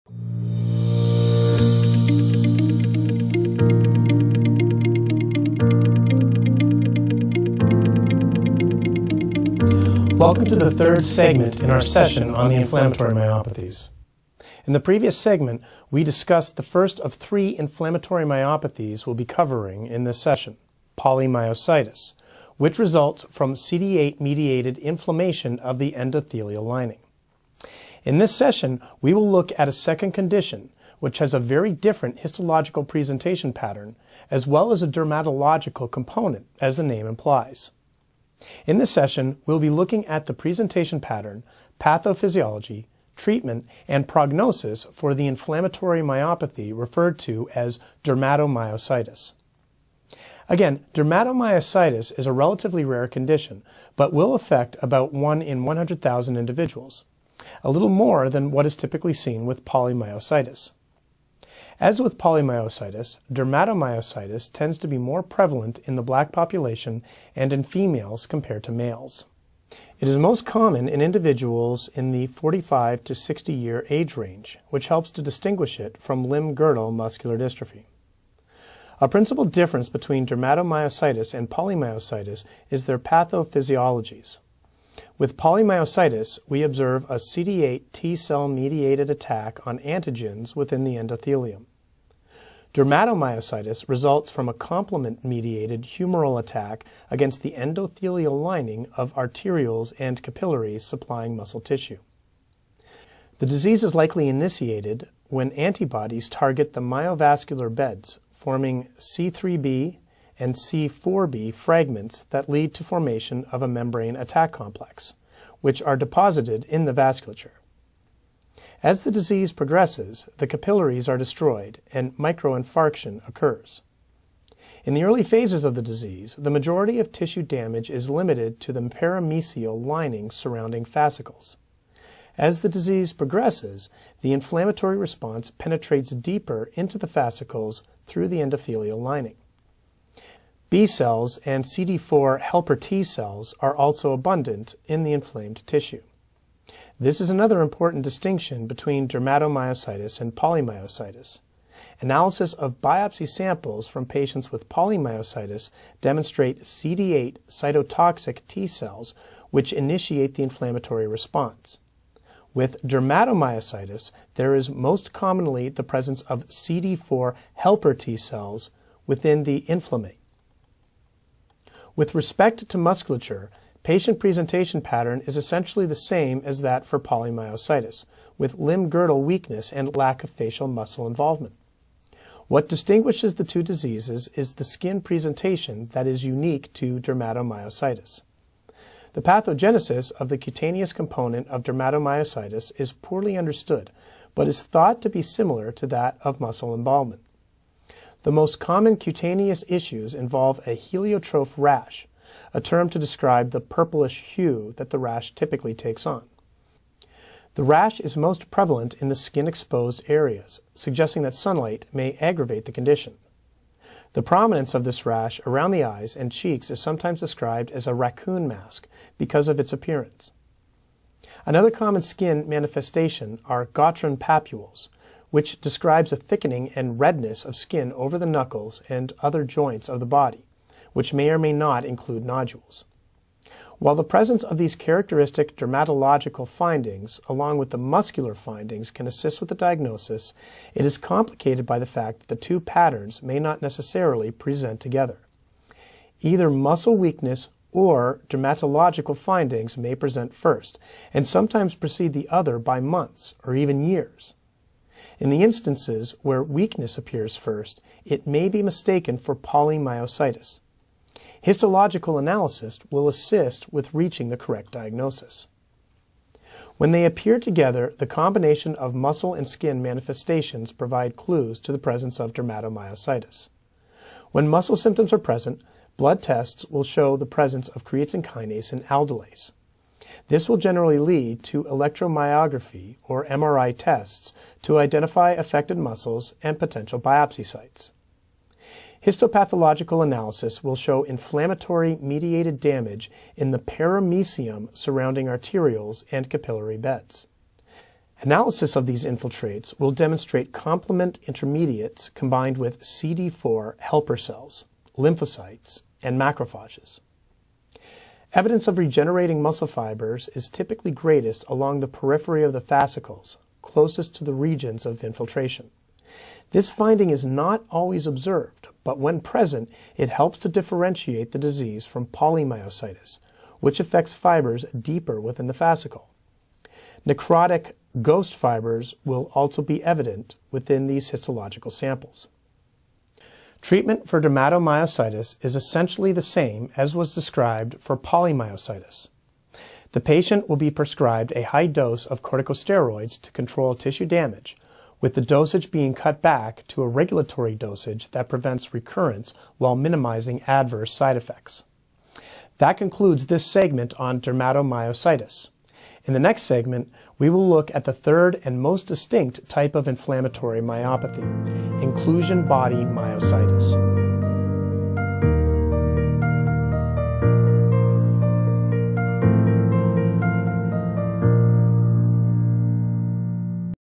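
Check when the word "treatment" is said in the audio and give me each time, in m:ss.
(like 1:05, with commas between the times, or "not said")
0:43, 5:33.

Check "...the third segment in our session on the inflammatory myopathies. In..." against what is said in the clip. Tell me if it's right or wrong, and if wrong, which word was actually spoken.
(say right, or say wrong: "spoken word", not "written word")
right.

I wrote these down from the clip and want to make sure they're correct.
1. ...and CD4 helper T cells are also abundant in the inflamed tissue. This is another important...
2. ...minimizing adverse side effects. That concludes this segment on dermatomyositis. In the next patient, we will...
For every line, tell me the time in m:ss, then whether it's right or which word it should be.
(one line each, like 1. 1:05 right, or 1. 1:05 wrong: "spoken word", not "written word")
1. 2:21 right
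2. 5:49 wrong: "segment", not "patient".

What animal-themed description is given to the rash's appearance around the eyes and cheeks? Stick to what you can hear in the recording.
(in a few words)
raccoon mask.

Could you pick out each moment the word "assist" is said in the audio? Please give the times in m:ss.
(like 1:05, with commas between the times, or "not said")
3:59, 4:23.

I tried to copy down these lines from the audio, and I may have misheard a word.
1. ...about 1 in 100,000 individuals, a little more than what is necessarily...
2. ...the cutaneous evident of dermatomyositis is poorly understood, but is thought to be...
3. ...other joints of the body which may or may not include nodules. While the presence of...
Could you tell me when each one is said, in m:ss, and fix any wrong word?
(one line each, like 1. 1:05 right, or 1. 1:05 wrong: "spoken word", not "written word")
1. 0:54 wrong: "typically", not "necessarily"
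2. 3:10 wrong: "component", not "evident"
3. 3:49 right.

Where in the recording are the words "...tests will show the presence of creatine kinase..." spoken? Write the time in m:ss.
4:36.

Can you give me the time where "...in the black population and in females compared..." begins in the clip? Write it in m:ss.
1:05.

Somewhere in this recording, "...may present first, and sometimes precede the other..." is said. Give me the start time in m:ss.
4:09.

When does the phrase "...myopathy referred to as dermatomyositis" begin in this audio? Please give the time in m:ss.
0:46.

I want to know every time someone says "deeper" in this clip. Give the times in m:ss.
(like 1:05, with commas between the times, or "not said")
2:16, 5:24.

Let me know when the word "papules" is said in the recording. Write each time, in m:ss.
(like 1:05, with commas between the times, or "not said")
3:44.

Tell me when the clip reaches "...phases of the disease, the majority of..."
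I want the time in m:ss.
2:05.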